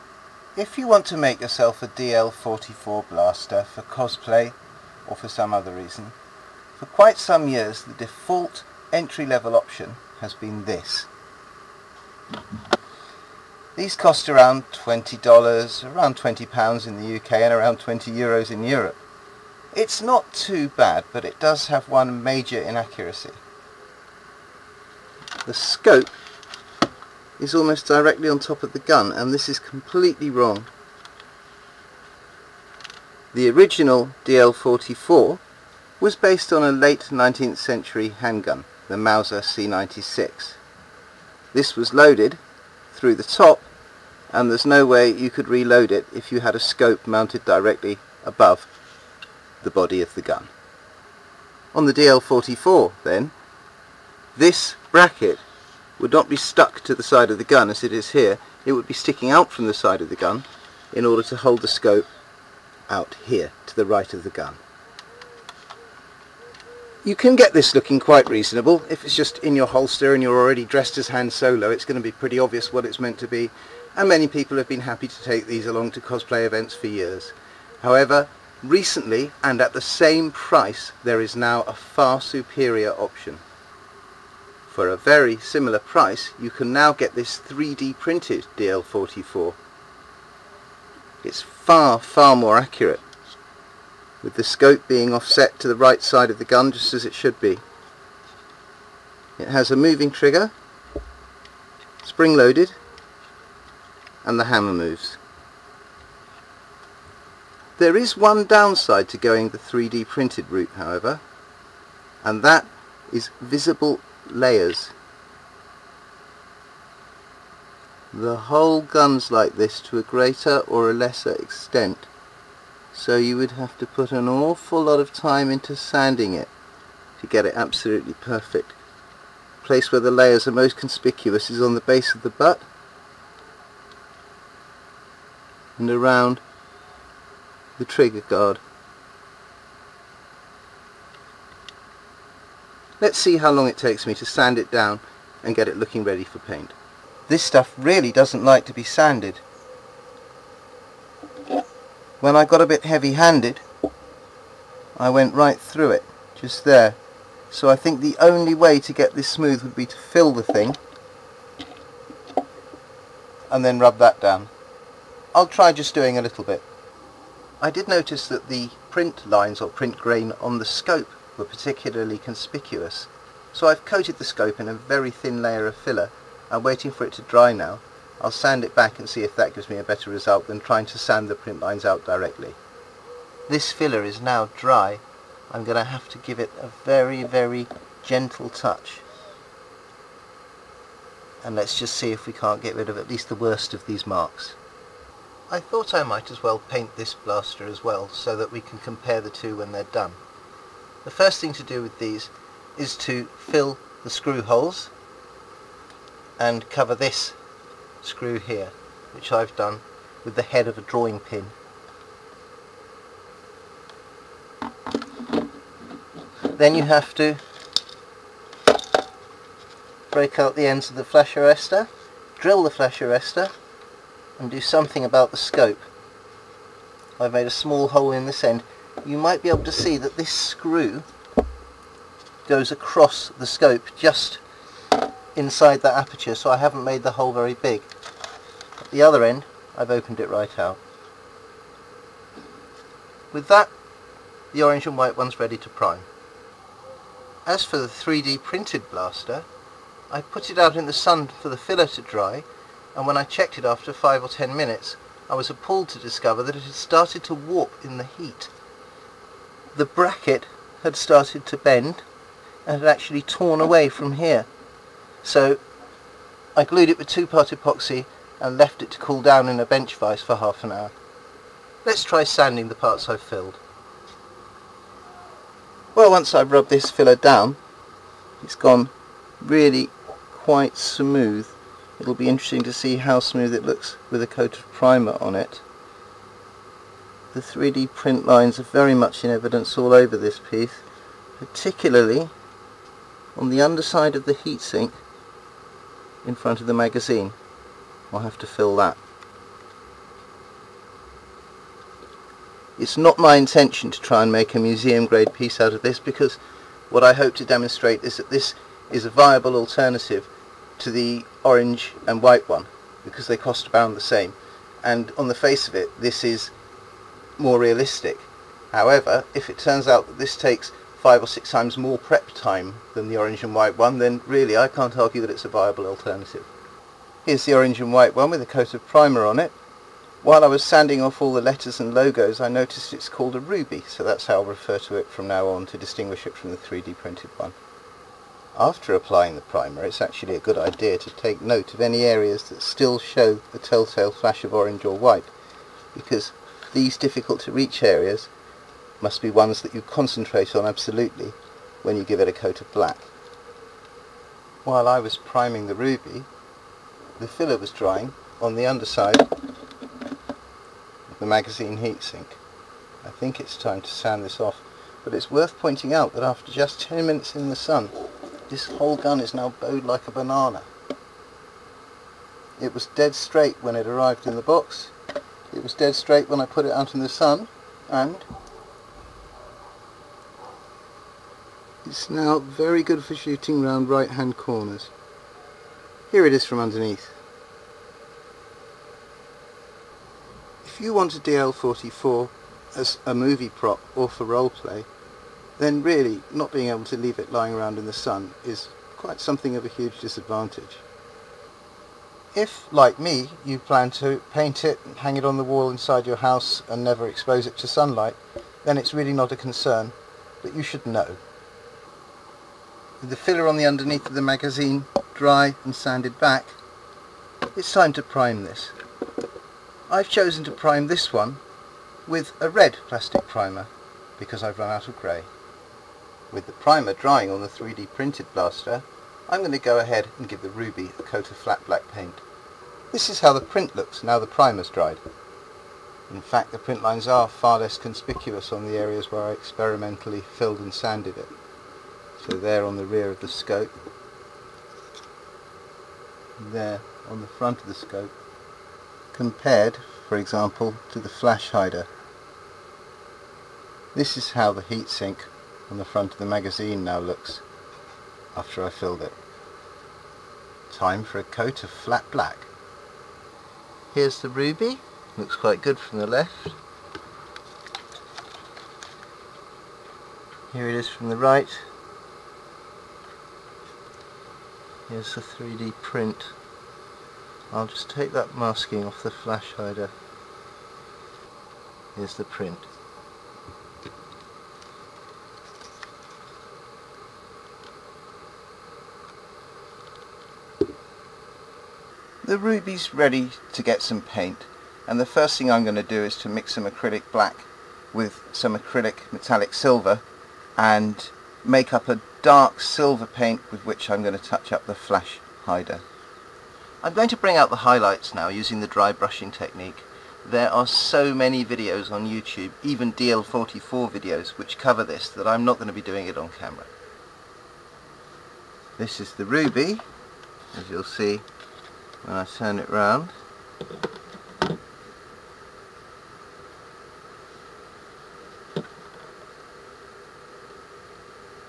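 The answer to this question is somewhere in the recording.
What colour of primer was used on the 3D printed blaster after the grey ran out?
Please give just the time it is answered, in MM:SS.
07:02.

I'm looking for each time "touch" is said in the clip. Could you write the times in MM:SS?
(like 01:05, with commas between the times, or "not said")
03:08, 08:24.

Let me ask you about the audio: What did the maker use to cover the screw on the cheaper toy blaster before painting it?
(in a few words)
a drawing pin.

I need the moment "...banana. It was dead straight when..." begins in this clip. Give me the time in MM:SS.
06:10.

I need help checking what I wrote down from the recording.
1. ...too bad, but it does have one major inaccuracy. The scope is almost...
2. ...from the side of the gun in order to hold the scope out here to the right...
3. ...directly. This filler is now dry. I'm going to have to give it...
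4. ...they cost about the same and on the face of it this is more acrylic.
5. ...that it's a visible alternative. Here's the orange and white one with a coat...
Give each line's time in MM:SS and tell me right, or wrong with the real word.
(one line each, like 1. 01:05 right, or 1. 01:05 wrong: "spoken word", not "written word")
1. 00:20 right
2. 00:59 right
3. 03:02 right
4. 05:13 wrong: "realistic", not "acrylic"
5. 05:25 wrong: "viable", not "visible".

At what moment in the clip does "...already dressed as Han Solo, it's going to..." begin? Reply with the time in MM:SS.
01:10.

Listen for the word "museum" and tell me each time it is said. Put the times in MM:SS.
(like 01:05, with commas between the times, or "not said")
05:04.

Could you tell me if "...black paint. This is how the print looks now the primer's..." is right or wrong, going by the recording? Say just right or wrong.
right.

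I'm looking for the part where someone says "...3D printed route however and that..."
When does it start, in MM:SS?
01:49.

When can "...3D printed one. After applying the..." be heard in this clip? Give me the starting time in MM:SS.
05:36.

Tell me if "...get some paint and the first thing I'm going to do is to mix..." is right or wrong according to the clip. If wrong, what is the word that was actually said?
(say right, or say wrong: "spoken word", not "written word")
right.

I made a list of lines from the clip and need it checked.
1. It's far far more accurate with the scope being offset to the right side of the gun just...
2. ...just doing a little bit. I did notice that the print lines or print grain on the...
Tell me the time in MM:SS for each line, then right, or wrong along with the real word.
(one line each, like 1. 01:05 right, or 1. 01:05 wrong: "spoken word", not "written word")
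1. 01:31 right
2. 02:45 right.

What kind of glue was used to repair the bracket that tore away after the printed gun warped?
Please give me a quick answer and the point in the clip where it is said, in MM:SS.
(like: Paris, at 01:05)
two-part epoxy, at 04:27.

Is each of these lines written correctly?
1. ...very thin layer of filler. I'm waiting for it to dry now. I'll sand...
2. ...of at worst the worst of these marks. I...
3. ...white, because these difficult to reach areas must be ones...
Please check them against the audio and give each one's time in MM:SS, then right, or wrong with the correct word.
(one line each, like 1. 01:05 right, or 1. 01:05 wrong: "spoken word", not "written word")
1. 02:54 right
2. 03:12 wrong: "least", not "worst"
3. 05:44 right.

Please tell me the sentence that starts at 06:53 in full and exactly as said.
With the filler on the underneath of the magazine dry and sanded back, it's time to prime this.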